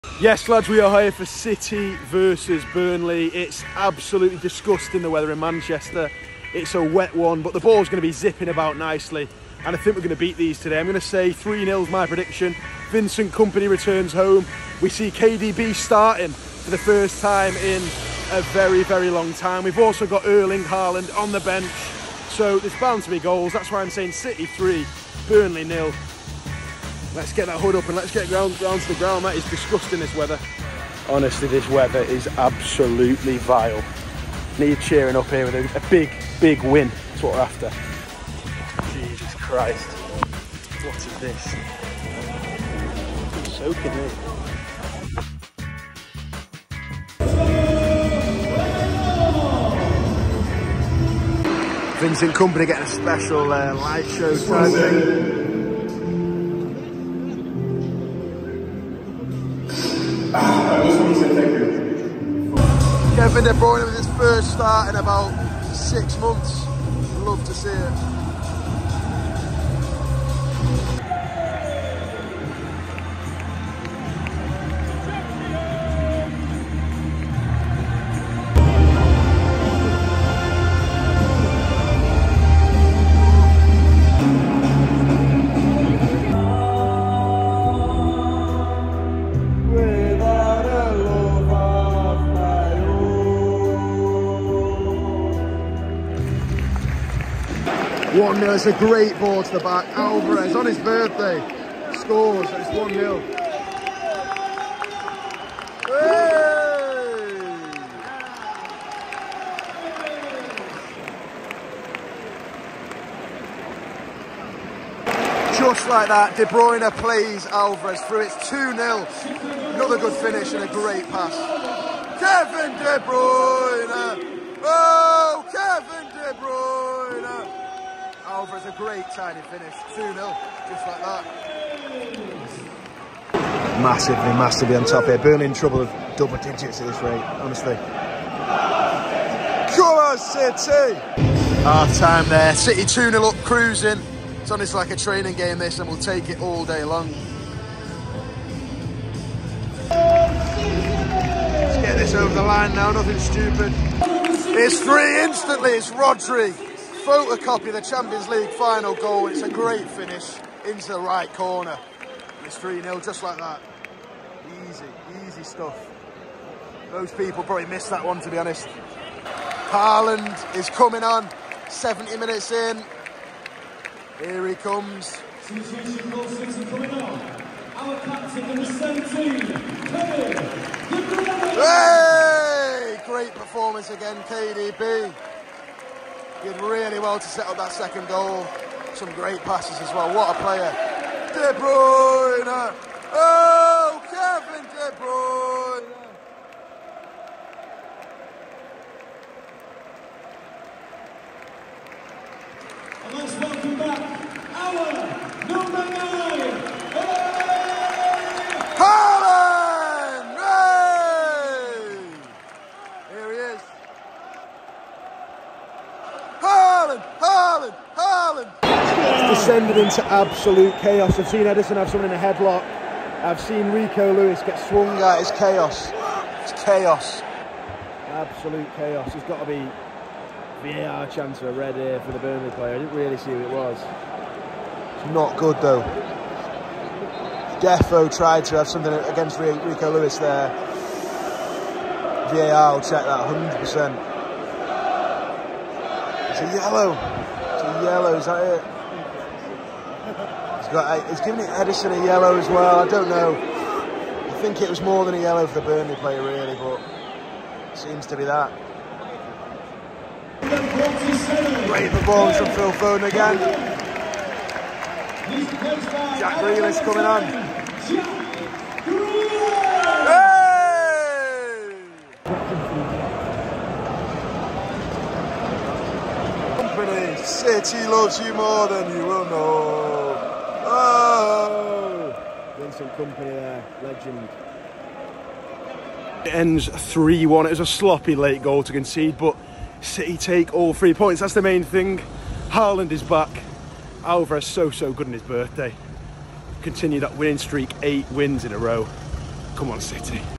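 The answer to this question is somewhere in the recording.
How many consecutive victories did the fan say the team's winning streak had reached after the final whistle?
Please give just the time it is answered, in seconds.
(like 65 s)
297 s.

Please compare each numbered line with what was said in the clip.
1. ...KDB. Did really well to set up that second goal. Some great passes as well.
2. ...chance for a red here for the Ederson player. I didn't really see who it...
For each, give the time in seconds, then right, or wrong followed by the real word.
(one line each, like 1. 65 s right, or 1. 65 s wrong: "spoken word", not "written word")
1. 184 s right
2. 231 s wrong: "Burnley", not "Ederson".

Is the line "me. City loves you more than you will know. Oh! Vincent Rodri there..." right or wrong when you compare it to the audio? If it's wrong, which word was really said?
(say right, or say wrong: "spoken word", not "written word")
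wrong: "Kompany", not "Rodri".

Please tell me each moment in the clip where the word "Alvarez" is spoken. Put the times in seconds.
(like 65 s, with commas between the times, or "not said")
99 s, 117 s, 294 s.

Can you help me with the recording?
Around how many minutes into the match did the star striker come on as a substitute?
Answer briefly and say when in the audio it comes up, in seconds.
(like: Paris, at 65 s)
70 minutes, at 171 s.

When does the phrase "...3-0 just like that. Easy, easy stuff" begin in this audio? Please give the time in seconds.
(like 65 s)
162 s.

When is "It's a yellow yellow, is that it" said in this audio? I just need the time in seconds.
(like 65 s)
246 s.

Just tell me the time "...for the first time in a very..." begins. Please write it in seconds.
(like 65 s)
16 s.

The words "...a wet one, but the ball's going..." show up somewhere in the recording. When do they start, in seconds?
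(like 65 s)
6 s.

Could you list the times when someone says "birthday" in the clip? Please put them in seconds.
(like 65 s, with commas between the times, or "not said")
100 s, 295 s.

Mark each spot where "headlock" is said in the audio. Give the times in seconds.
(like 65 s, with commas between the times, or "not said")
222 s.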